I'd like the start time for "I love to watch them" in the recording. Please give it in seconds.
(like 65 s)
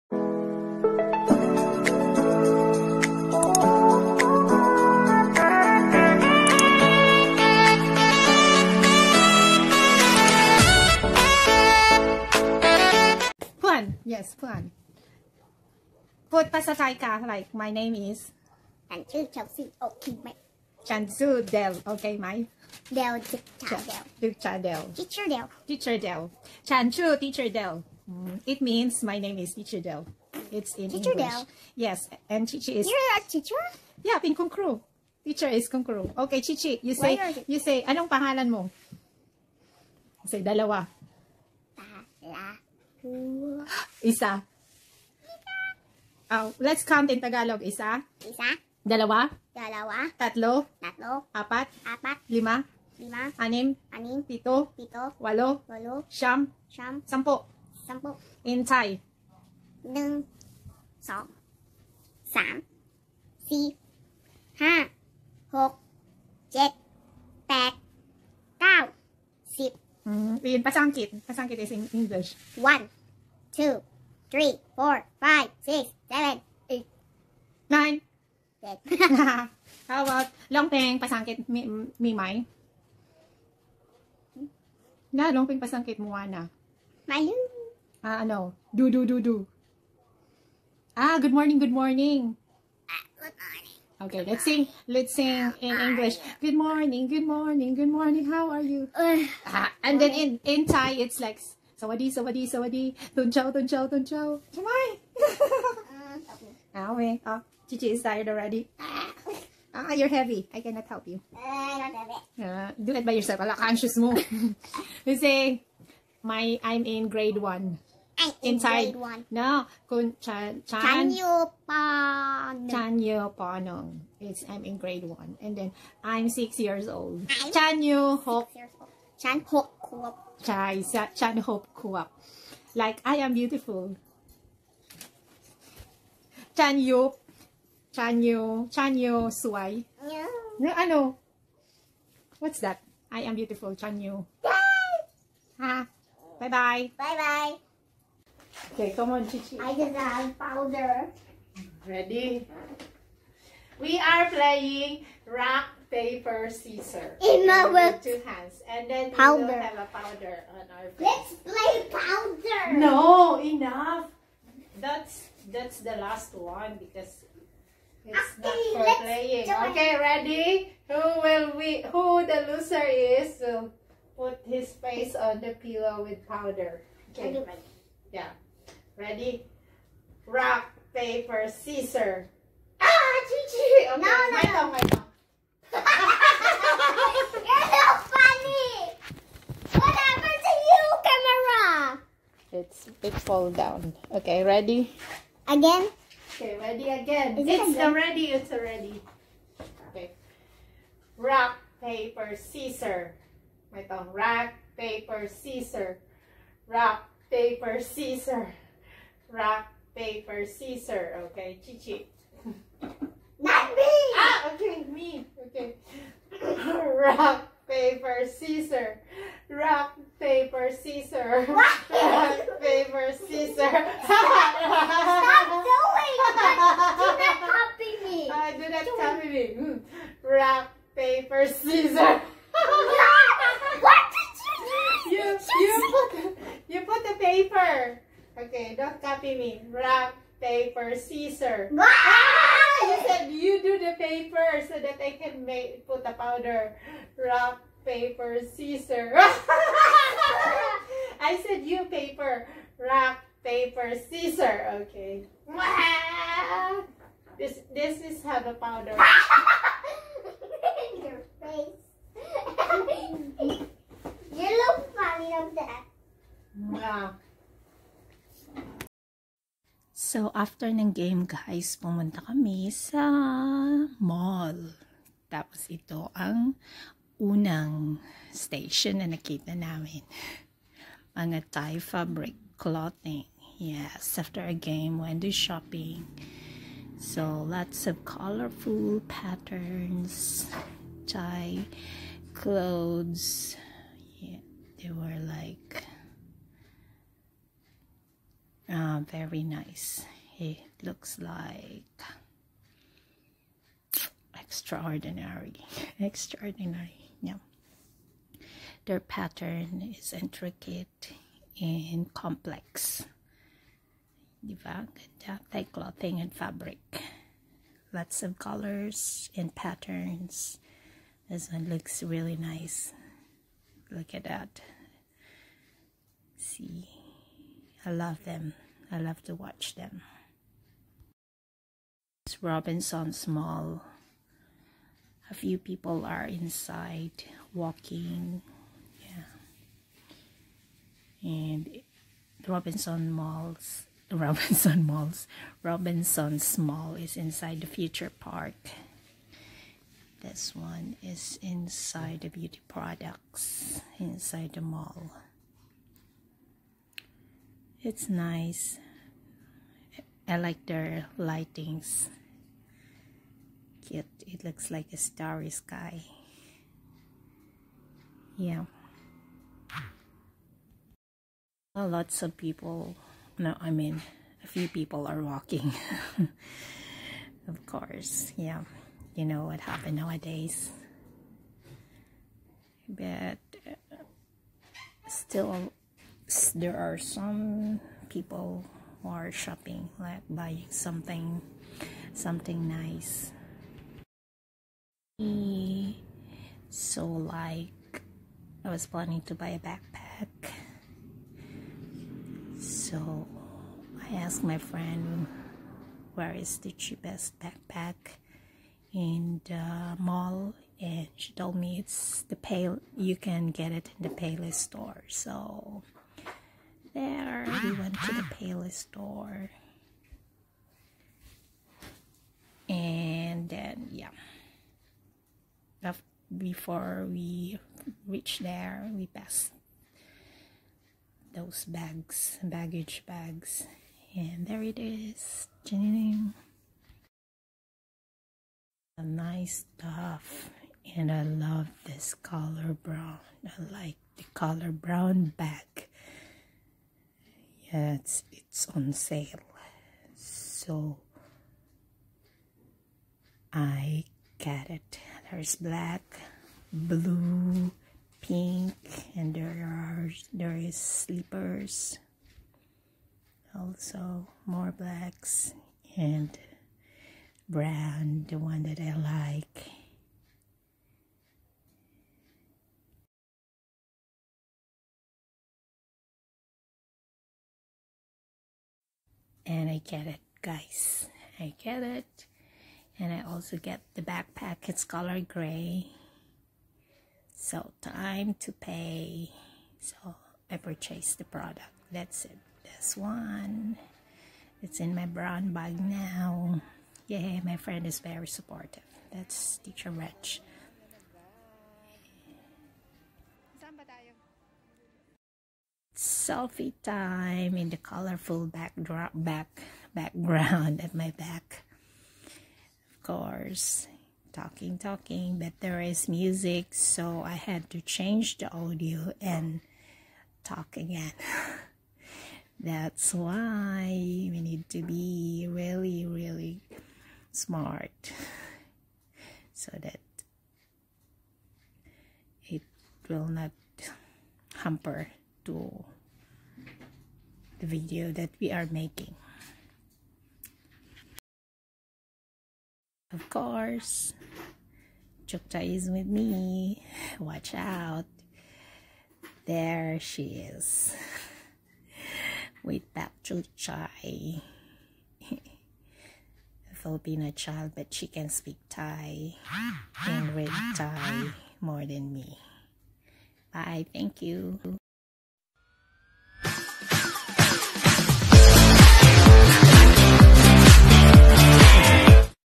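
328 s.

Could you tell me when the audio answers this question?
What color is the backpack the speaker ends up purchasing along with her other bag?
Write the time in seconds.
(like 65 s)
485 s.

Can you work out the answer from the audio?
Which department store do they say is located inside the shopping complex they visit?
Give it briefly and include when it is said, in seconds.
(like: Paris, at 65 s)
Robinson Mall, at 345 s.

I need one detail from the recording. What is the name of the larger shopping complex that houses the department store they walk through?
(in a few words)
Future Park.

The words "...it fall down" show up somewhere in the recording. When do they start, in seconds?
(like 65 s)
193 s.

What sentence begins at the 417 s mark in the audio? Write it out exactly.
We went to the Payless store.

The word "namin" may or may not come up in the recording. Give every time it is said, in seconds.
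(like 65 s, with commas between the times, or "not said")
279 s.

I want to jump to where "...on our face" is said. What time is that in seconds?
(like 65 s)
160 s.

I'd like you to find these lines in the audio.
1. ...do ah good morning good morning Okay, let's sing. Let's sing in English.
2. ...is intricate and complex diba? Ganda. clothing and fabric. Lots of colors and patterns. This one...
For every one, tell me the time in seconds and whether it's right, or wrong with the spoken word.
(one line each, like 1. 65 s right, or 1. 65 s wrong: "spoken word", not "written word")
1. 89 s right
2. 309 s right.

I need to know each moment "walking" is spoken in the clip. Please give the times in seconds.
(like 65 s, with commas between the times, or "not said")
337 s, 375 s.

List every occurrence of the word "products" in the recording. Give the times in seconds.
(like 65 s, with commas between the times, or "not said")
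352 s, 491 s.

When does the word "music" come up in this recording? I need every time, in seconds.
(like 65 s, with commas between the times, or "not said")
516 s.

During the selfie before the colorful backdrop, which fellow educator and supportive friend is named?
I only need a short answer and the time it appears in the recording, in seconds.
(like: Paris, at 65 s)
Teacher Rich, at 499 s.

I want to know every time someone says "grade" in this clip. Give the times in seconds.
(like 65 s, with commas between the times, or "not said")
117 s, 124 s.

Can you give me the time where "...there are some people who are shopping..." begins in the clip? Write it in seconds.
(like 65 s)
386 s.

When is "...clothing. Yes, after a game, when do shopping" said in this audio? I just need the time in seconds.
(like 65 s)
282 s.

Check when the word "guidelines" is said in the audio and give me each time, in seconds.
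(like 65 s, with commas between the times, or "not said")
not said.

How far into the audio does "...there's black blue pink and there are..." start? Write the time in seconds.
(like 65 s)
455 s.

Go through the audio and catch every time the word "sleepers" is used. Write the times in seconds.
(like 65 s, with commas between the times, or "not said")
460 s.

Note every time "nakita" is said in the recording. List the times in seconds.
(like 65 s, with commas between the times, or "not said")
279 s.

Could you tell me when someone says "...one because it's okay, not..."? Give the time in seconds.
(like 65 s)
166 s.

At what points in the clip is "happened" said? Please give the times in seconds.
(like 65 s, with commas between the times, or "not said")
189 s, 379 s.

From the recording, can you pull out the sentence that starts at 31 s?
yes and teacher is you're a teacher yeah เ ป ็ น ค ุ ณ ค ร ู teacher is Kru.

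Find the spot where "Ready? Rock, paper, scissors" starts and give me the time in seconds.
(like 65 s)
178 s.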